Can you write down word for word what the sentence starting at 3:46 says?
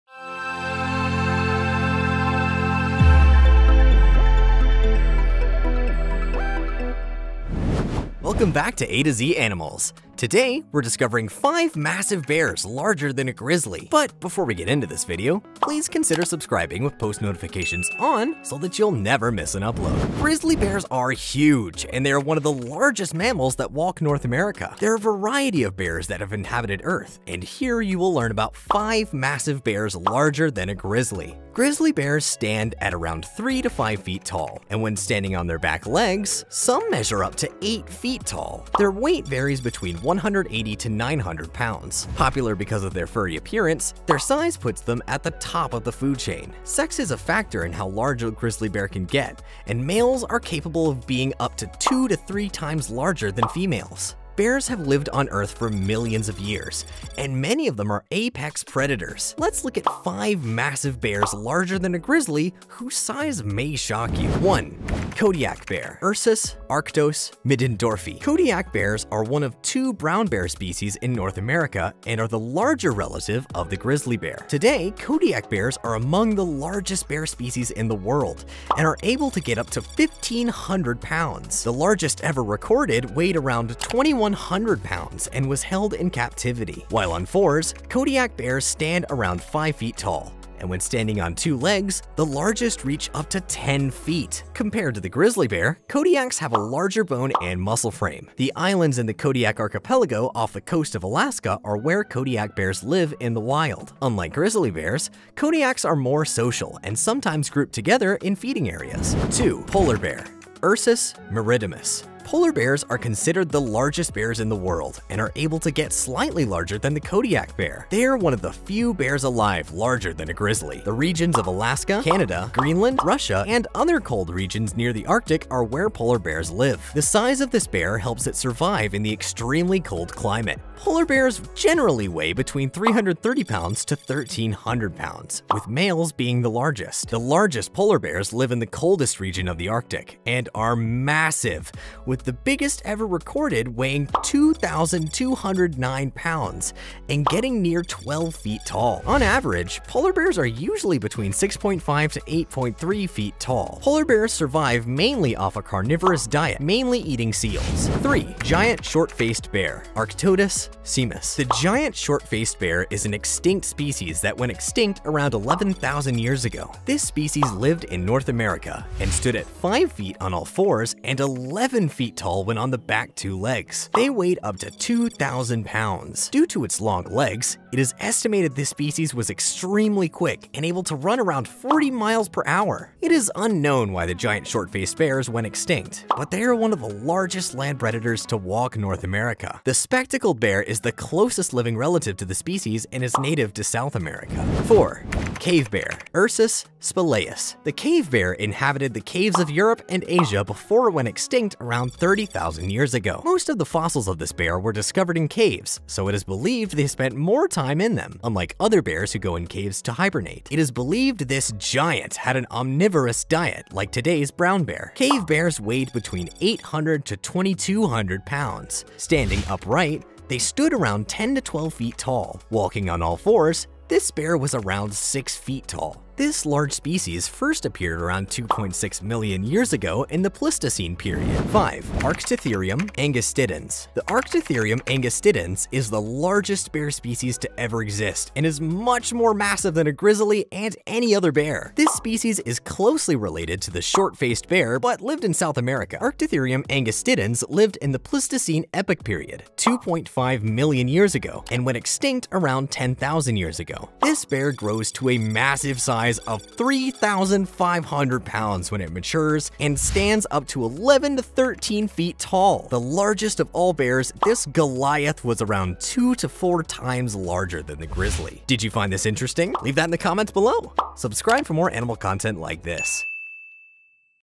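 This large species first appeared around 2.6 million years ago in the Pleistocene period.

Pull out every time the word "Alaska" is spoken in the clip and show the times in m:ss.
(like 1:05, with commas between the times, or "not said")
1:41, 2:01.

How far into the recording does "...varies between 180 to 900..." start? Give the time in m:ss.
0:39.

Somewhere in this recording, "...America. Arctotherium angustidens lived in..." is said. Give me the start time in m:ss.
4:05.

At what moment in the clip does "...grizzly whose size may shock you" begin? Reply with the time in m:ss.
1:01.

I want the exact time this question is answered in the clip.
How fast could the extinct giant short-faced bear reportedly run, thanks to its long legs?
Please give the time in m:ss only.
3:01.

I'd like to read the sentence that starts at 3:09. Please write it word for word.
The spectacled bear is the closest living relative to the species and is native to South America.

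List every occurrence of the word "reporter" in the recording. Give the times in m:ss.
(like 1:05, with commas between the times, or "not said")
not said.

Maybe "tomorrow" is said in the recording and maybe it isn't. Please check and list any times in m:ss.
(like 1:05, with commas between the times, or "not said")
not said.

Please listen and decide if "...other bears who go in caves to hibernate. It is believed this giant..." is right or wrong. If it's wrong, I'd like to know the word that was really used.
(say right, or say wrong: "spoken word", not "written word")
right.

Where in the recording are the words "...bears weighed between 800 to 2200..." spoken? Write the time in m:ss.
3:35.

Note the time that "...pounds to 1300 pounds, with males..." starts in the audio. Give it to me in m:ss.
2:13.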